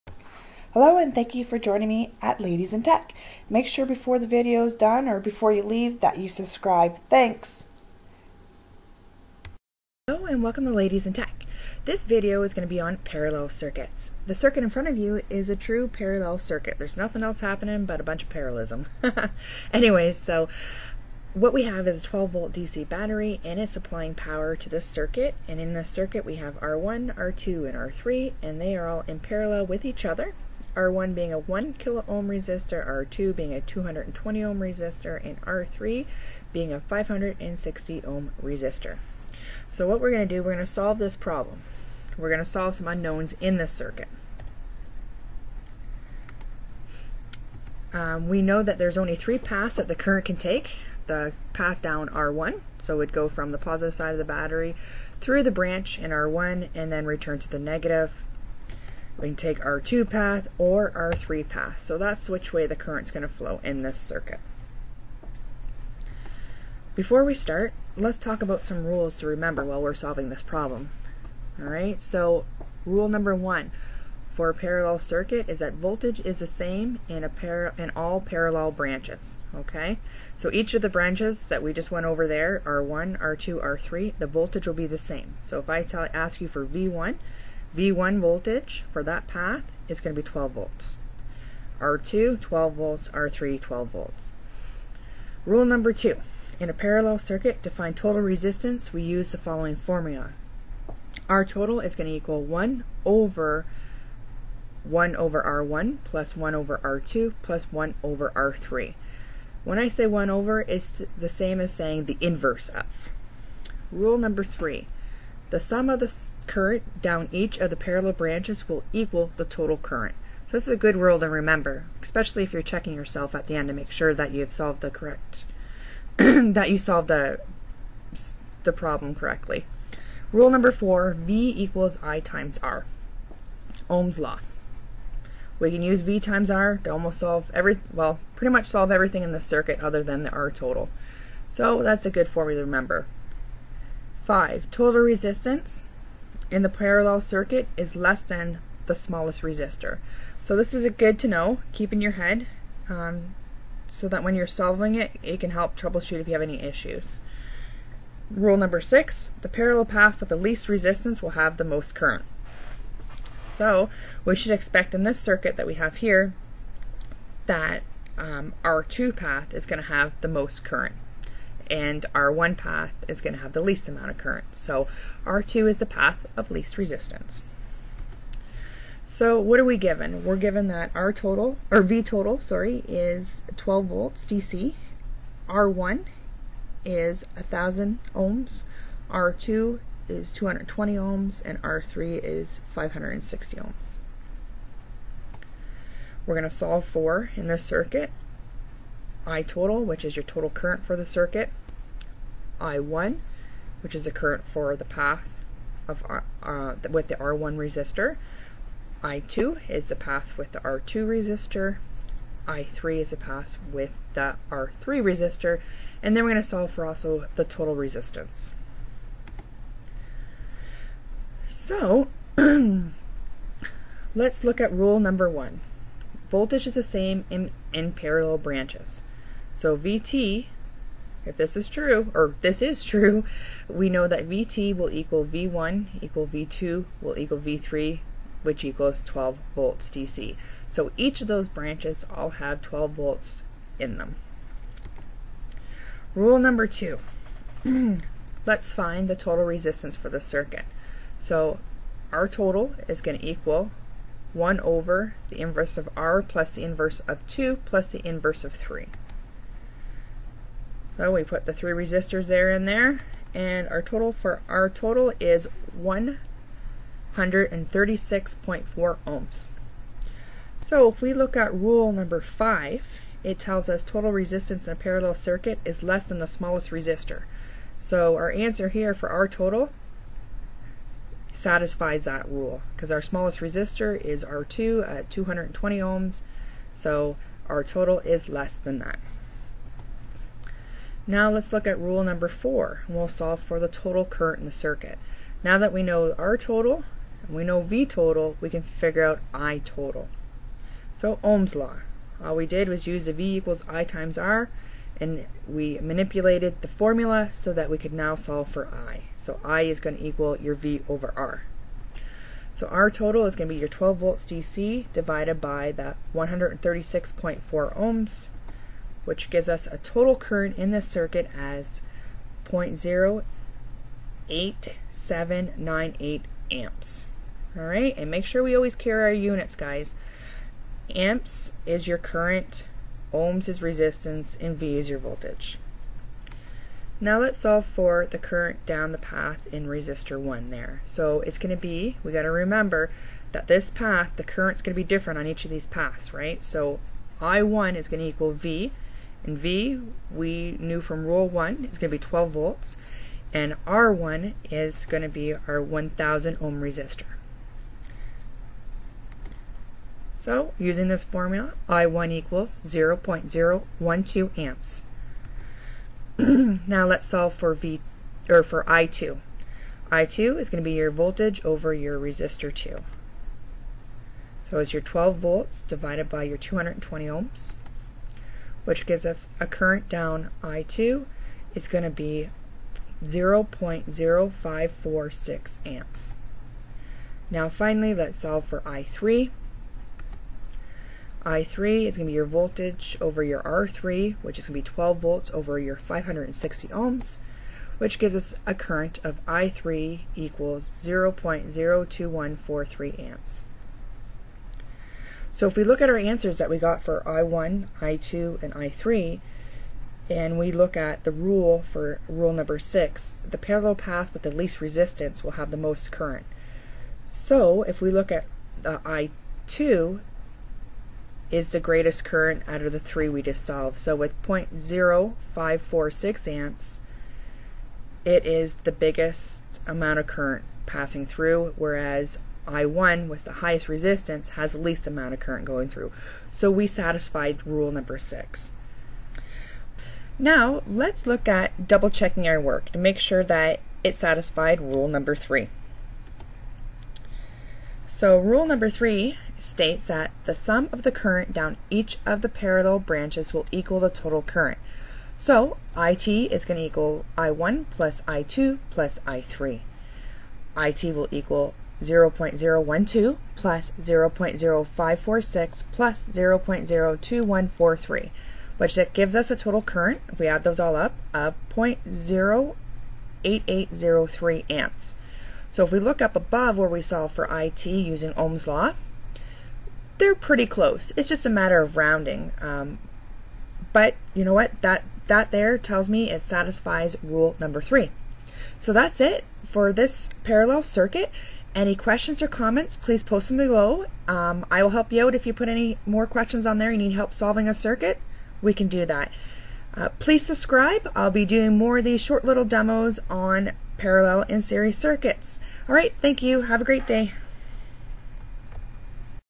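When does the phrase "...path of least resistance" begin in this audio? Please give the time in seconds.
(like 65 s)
175 s.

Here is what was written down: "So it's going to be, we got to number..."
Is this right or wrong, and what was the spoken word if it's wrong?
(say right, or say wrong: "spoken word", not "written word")
wrong: "remember", not "number".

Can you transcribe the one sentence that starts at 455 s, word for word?
So IT is going to equal I1 plus I2 plus I3.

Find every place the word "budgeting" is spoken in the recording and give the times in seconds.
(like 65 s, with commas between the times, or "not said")
not said.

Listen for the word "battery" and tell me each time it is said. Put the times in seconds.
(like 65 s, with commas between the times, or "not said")
22 s, 54 s.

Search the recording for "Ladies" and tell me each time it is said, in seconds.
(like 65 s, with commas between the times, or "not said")
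2 s, 10 s.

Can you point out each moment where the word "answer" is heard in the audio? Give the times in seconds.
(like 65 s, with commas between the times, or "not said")
278 s, 405 s.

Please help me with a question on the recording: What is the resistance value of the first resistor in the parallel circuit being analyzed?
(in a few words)
1 kilo ohm.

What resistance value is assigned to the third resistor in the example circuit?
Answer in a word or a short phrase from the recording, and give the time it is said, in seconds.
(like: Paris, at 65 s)
560 ohm, at 36 s.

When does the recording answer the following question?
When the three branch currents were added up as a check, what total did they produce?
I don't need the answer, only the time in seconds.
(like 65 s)
471 s.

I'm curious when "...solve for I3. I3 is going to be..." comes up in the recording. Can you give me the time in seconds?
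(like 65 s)
388 s.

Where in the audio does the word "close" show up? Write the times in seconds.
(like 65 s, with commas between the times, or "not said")
480 s.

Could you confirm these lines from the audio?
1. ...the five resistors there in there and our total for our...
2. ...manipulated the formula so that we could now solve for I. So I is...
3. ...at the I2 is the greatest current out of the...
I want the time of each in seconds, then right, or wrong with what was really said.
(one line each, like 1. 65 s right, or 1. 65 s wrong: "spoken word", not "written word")
1. 261 s wrong: "three", not "five"
2. 305 s right
3. 418 s right.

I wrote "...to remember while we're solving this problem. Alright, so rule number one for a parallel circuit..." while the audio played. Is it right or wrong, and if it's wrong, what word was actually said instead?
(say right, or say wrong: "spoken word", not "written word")
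right.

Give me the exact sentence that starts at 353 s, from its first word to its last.
And R1 is going to be our 1000 ohm resistor.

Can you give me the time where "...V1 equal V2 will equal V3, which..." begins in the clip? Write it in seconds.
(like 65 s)
235 s.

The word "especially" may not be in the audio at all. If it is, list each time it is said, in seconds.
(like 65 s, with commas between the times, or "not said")
122 s.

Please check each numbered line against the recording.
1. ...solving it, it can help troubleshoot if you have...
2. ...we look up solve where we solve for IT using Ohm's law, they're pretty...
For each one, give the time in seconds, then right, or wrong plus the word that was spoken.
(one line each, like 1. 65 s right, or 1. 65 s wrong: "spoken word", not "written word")
1. 154 s right
2. 475 s wrong: "above", not "solve".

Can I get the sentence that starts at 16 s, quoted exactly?
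There's nothing else happening but a bunch of parallelism.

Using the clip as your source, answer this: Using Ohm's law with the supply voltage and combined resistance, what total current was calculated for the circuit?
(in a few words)
0.08798 amps.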